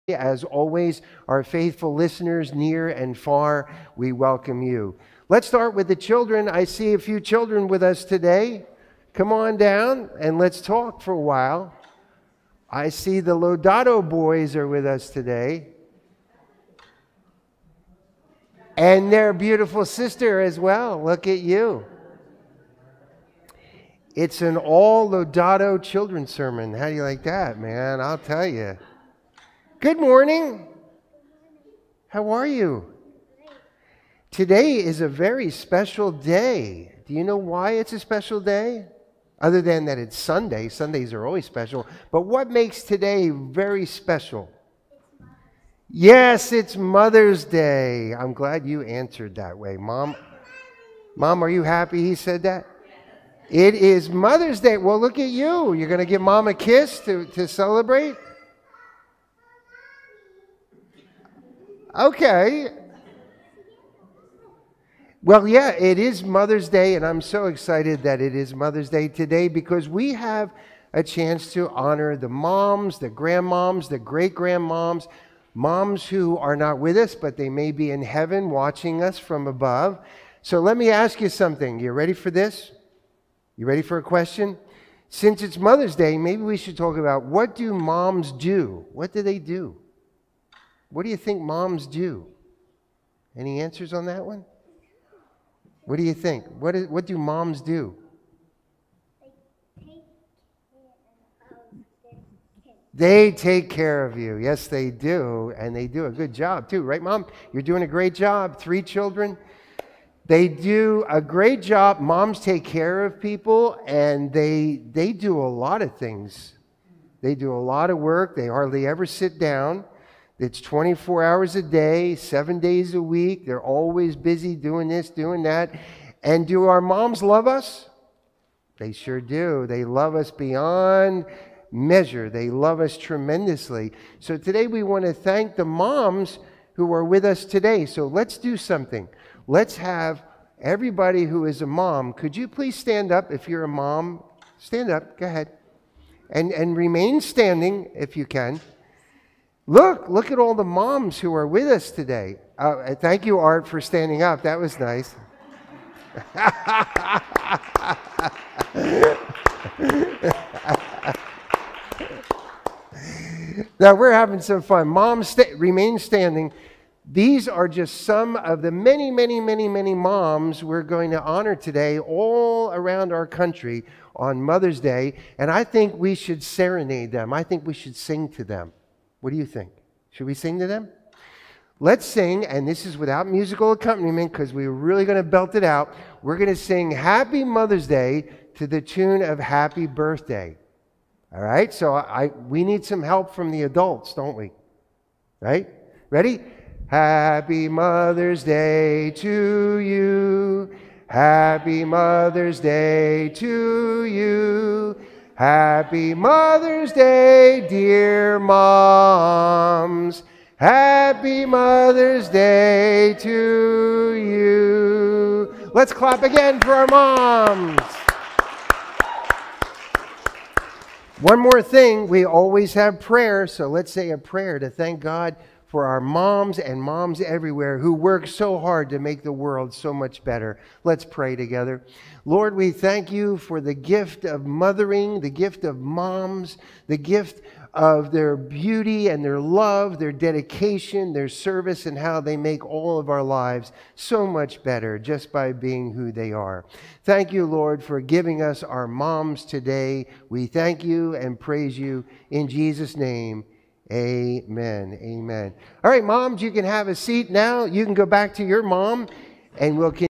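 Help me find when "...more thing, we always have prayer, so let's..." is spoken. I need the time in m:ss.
3:41.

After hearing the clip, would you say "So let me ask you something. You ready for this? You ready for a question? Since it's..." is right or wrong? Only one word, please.
right.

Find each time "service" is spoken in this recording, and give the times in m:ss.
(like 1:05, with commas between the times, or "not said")
4:01.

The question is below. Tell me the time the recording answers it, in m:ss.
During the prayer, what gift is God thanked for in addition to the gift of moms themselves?
3:53.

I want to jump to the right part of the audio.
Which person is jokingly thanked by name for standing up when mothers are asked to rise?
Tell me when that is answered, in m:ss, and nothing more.
2:33.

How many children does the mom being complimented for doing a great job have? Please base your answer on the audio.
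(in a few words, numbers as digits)
3.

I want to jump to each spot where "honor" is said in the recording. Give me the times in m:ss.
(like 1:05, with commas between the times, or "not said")
1:11, 2:51.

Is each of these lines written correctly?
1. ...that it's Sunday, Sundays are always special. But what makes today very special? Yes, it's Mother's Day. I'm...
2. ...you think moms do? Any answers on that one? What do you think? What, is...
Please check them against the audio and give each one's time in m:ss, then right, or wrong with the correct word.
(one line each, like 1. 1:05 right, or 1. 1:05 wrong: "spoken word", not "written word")
1. 0:39 right
2. 1:31 right.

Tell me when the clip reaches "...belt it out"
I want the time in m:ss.
3:05.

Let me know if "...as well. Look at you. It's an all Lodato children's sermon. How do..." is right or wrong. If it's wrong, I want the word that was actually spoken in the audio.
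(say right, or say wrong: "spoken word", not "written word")
right.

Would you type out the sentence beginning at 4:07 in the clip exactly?
Thank you, Lord, for giving us our moms today.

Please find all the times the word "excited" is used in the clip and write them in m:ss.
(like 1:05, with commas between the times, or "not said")
1:07.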